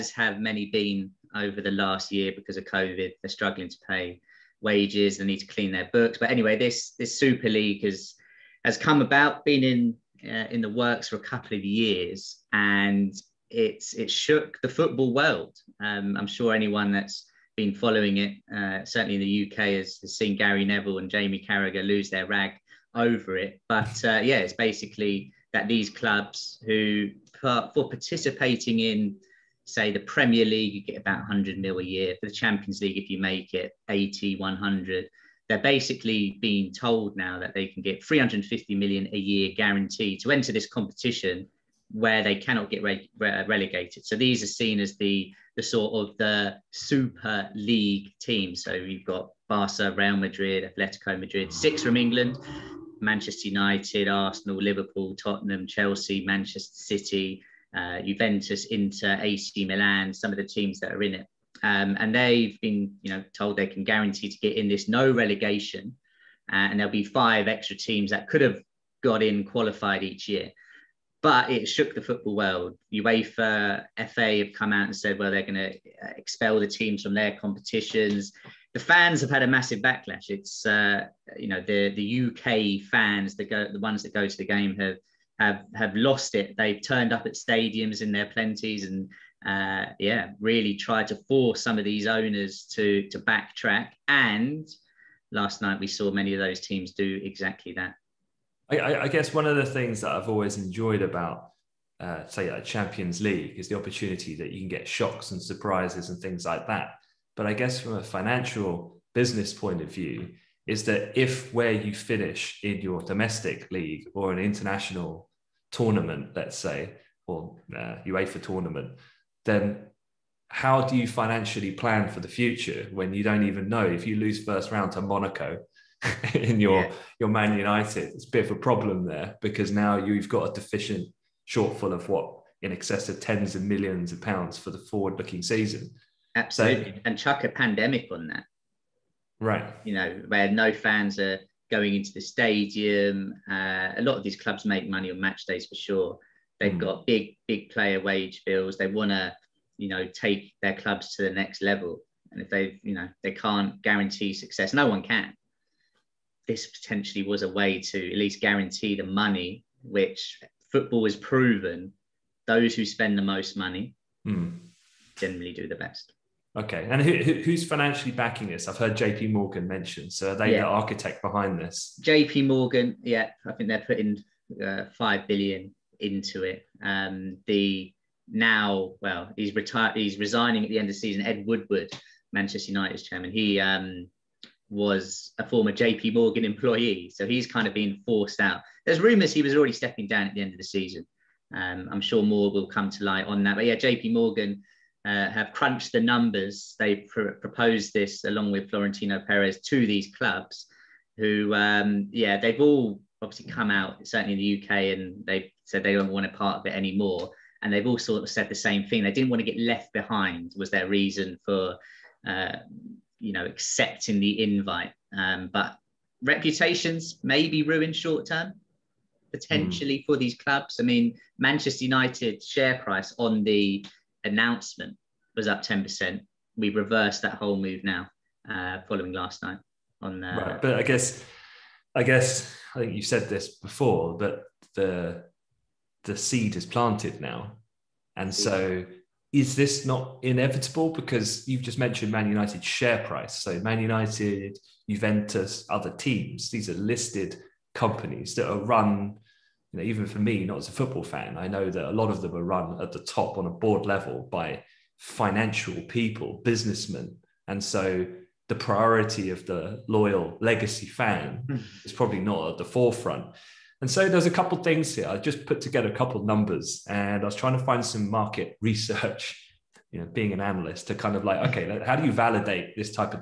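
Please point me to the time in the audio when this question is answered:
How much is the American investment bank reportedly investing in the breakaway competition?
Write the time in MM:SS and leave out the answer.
02:54.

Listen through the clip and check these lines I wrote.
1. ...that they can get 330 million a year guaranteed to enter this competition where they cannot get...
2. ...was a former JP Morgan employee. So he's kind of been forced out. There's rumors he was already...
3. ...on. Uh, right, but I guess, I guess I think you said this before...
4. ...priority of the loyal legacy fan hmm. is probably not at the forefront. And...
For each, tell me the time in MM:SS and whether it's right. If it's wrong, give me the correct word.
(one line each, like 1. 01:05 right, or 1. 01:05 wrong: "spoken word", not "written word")
1. 00:37 wrong: "350", not "330"
2. 03:04 right
3. 03:50 right
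4. 04:18 right.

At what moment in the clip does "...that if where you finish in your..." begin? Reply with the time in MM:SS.
01:50.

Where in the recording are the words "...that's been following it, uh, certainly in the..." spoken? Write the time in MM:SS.
00:16.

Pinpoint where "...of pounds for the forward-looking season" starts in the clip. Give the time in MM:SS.
02:14.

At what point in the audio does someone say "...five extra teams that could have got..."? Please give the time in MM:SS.
01:07.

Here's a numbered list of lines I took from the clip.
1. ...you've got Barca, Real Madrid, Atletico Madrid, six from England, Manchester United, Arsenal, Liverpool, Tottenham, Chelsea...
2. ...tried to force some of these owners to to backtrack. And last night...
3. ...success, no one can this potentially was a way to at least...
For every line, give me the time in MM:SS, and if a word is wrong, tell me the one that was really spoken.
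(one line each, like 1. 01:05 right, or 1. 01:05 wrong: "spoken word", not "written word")
1. 00:48 right
2. 01:30 right
3. 02:34 right.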